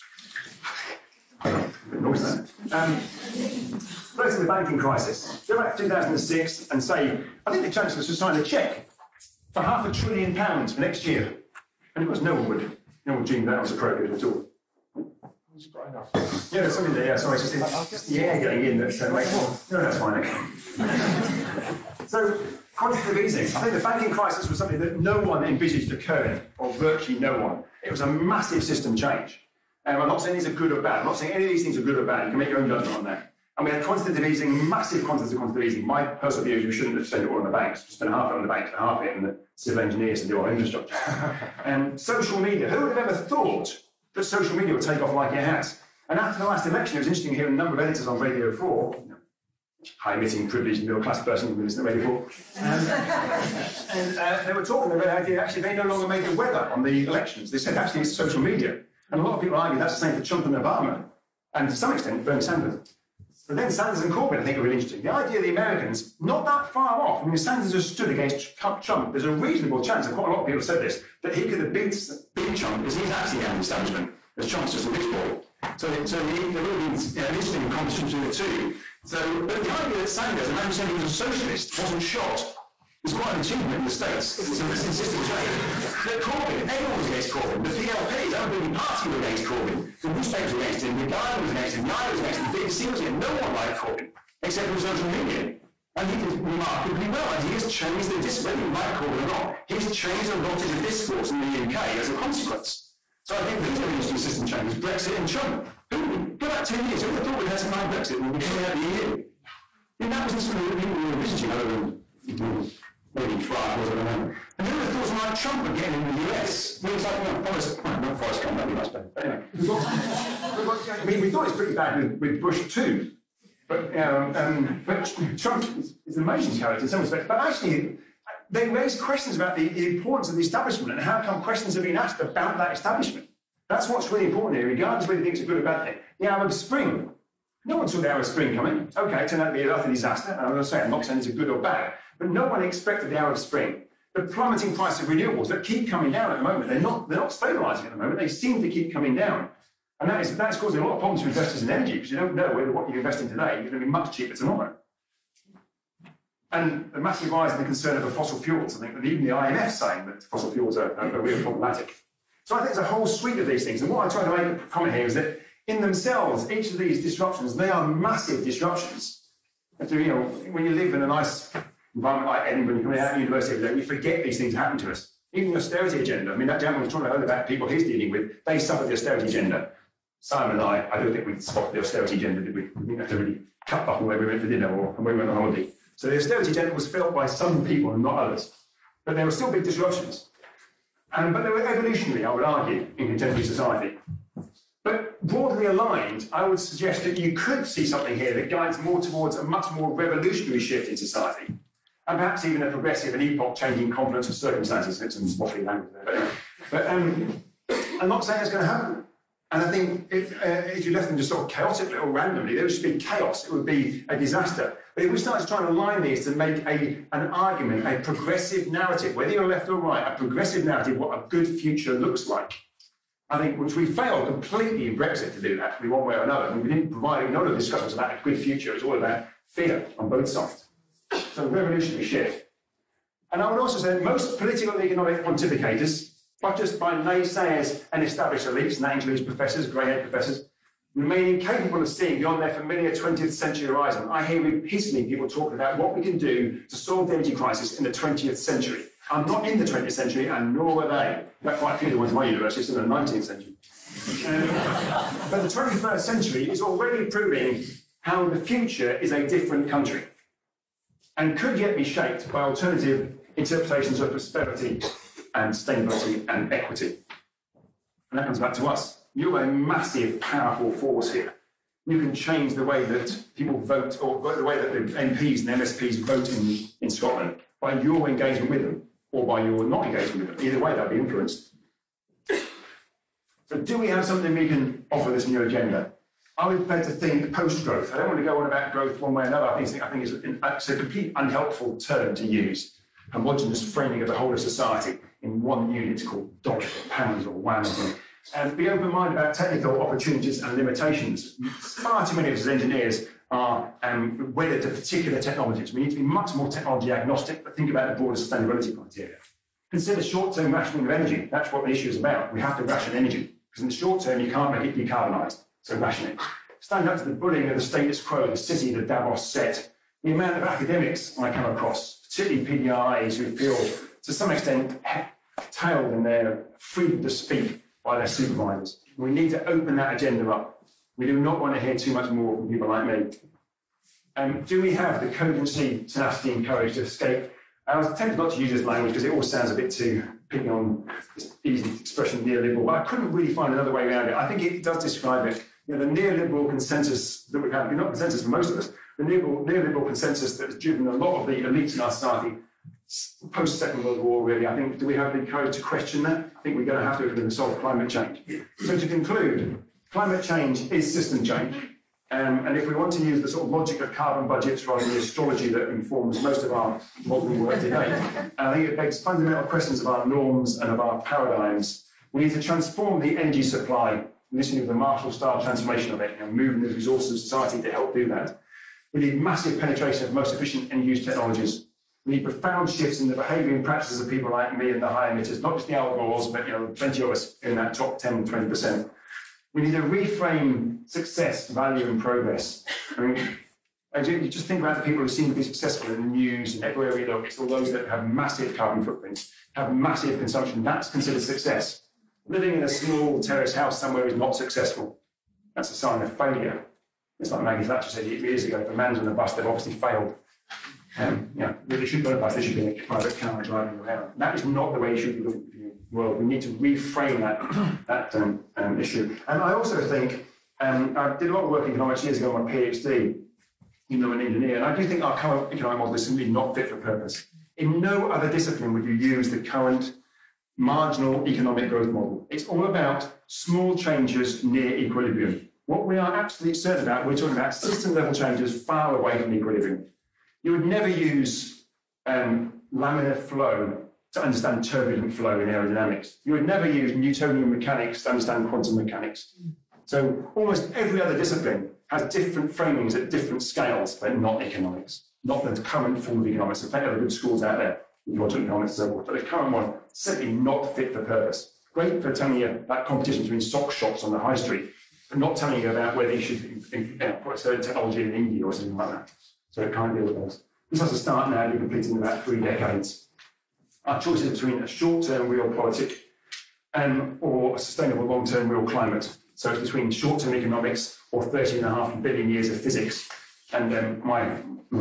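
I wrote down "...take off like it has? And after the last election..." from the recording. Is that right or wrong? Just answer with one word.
right.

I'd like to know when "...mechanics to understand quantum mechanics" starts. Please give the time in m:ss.
7:27.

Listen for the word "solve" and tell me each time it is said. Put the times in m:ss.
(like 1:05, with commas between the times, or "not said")
4:06, 5:57.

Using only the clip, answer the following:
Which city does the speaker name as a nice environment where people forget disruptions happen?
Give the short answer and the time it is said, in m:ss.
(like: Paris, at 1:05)
Edinburgh, at 2:52.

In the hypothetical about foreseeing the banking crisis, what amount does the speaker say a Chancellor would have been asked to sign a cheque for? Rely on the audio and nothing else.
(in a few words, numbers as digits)
half a trillion pounds.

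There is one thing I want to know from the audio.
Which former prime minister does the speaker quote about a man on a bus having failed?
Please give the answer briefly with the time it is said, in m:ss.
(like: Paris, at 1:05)
Maggie Thatcher, at 6:47.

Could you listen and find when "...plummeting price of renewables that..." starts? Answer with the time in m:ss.
2:24.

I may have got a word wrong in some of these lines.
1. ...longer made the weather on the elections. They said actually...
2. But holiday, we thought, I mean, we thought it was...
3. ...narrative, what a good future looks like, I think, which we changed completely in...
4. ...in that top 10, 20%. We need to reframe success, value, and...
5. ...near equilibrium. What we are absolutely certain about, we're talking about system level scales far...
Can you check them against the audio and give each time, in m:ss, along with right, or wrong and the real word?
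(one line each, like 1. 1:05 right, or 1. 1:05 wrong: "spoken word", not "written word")
1. 0:55 right
2. 1:59 wrong: "anyway", not "holiday"
3. 3:40 wrong: "failed", not "changed"
4. 6:27 right
5. 7:14 wrong: "changes", not "scales".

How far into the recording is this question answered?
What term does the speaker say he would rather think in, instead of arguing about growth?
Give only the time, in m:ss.
4:47.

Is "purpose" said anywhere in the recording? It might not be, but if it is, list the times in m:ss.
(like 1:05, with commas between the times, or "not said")
7:06, 7:41.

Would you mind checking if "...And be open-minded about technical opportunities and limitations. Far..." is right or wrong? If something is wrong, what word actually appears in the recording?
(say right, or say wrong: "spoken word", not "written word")
right.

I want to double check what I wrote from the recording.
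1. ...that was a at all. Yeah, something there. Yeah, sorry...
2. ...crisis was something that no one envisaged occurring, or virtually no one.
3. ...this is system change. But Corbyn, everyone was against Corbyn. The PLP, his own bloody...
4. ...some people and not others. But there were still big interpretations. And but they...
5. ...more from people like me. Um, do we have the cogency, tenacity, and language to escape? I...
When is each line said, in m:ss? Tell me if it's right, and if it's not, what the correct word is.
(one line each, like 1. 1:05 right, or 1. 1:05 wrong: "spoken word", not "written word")
1. 0:13 right
2. 0:24 right
3. 1:24 right
4. 3:07 wrong: "disruptions", not "interpretations"
5. 5:32 wrong: "courage", not "language".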